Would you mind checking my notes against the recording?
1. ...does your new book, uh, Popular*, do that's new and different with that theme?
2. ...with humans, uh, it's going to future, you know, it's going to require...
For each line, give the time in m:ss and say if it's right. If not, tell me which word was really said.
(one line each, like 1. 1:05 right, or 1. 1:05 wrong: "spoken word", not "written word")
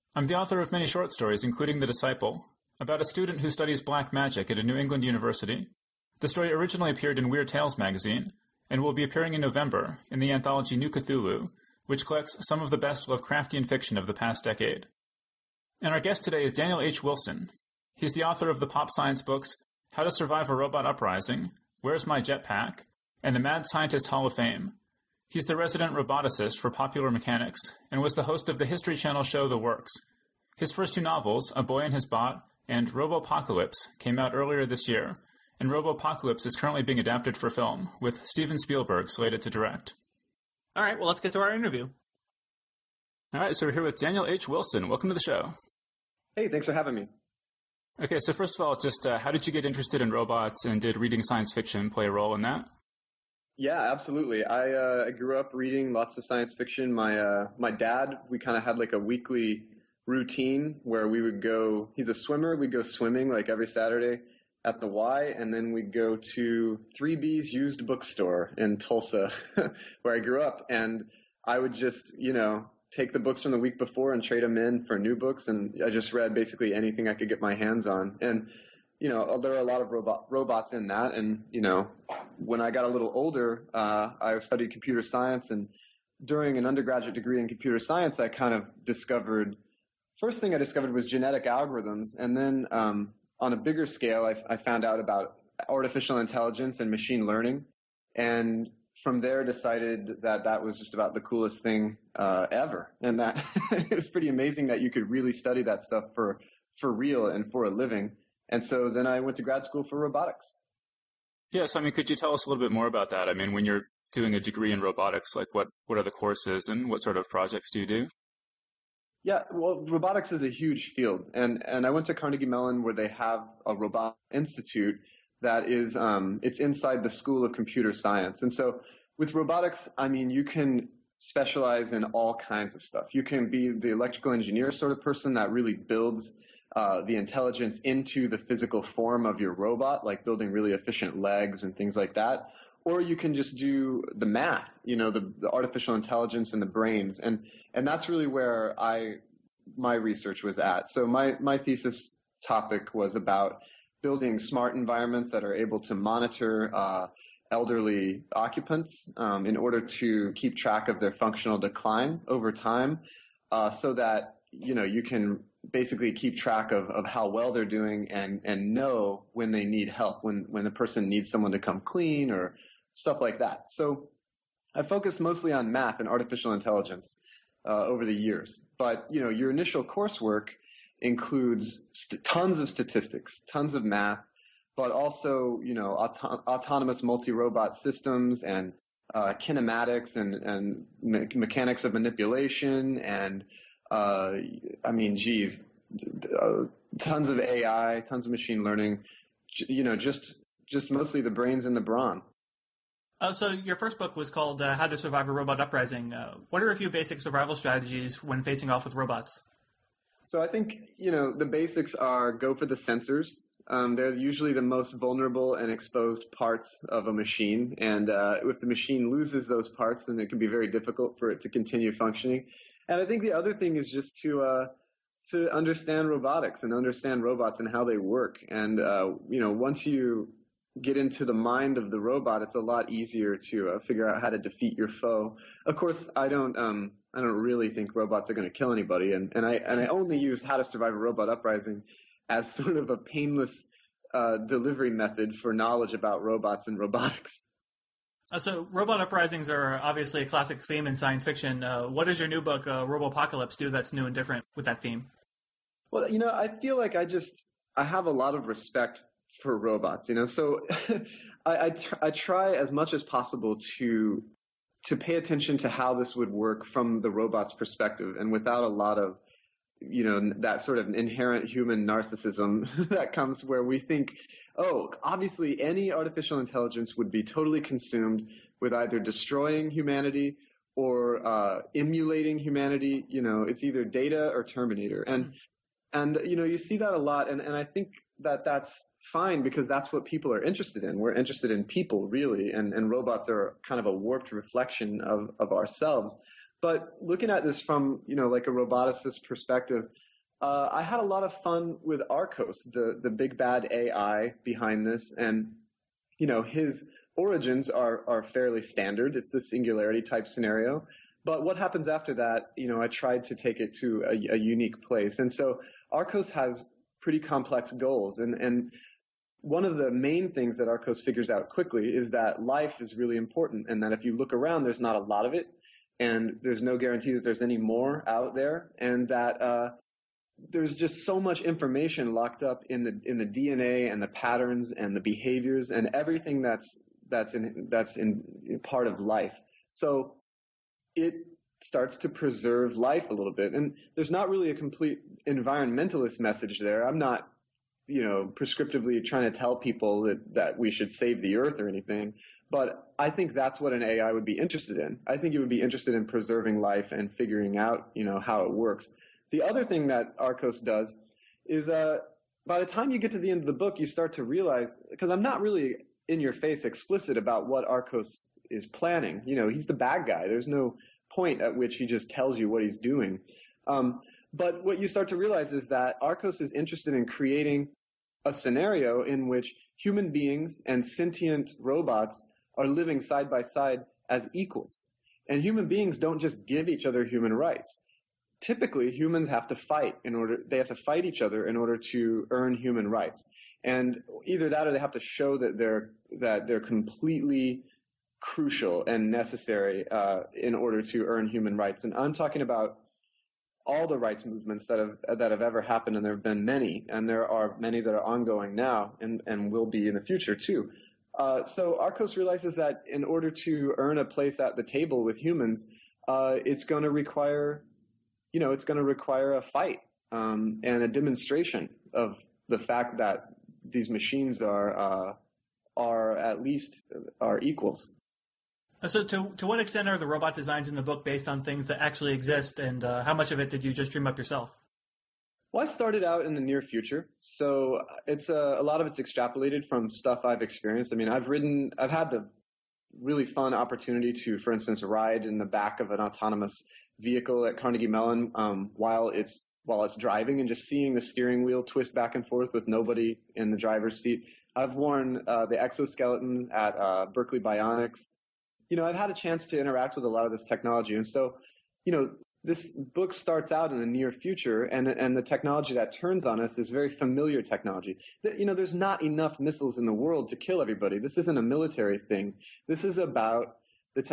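1. 4:12 wrong: "Apocalypse", not "Popular"
2. 6:55 wrong: "require", not "future".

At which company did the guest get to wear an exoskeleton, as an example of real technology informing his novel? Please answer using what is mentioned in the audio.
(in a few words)
Berkeley Bionics.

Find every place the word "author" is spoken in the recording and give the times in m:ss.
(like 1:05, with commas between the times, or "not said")
0:00, 0:18.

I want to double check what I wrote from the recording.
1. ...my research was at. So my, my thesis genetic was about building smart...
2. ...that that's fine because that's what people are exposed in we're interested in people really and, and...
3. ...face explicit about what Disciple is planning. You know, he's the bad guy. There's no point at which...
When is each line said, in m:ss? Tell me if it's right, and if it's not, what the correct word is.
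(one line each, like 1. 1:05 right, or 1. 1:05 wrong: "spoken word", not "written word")
1. 2:29 wrong: "topic", not "genetic"
2. 4:48 wrong: "interested", not "exposed"
3. 6:06 wrong: "Archos", not "Disciple".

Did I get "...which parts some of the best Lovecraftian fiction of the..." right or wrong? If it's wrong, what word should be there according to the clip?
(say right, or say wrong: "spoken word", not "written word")
wrong: "collects", not "parts".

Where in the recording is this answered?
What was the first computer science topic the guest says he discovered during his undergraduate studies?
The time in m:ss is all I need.
1:31.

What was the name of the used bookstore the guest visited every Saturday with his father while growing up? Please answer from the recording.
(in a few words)
Three B's.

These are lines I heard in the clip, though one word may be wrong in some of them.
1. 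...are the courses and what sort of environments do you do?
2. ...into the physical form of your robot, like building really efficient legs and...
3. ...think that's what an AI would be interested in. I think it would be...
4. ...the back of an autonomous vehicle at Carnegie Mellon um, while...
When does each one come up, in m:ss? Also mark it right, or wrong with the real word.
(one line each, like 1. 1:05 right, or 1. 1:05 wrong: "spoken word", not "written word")
1. 1:55 wrong: "projects", not "environments"
2. 2:17 right
3. 5:53 right
4. 7:25 right.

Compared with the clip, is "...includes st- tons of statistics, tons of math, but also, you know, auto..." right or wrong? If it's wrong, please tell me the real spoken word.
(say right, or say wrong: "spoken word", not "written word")
right.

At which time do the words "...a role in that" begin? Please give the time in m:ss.
0:52.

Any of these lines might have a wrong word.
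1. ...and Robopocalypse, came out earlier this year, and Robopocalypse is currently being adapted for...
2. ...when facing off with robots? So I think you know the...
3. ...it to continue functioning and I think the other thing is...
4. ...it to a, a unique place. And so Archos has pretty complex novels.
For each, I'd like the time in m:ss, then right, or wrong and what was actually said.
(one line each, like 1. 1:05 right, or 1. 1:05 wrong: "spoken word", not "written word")
1. 0:32 right
2. 3:28 right
3. 3:41 right
4. 5:13 wrong: "goals", not "novels".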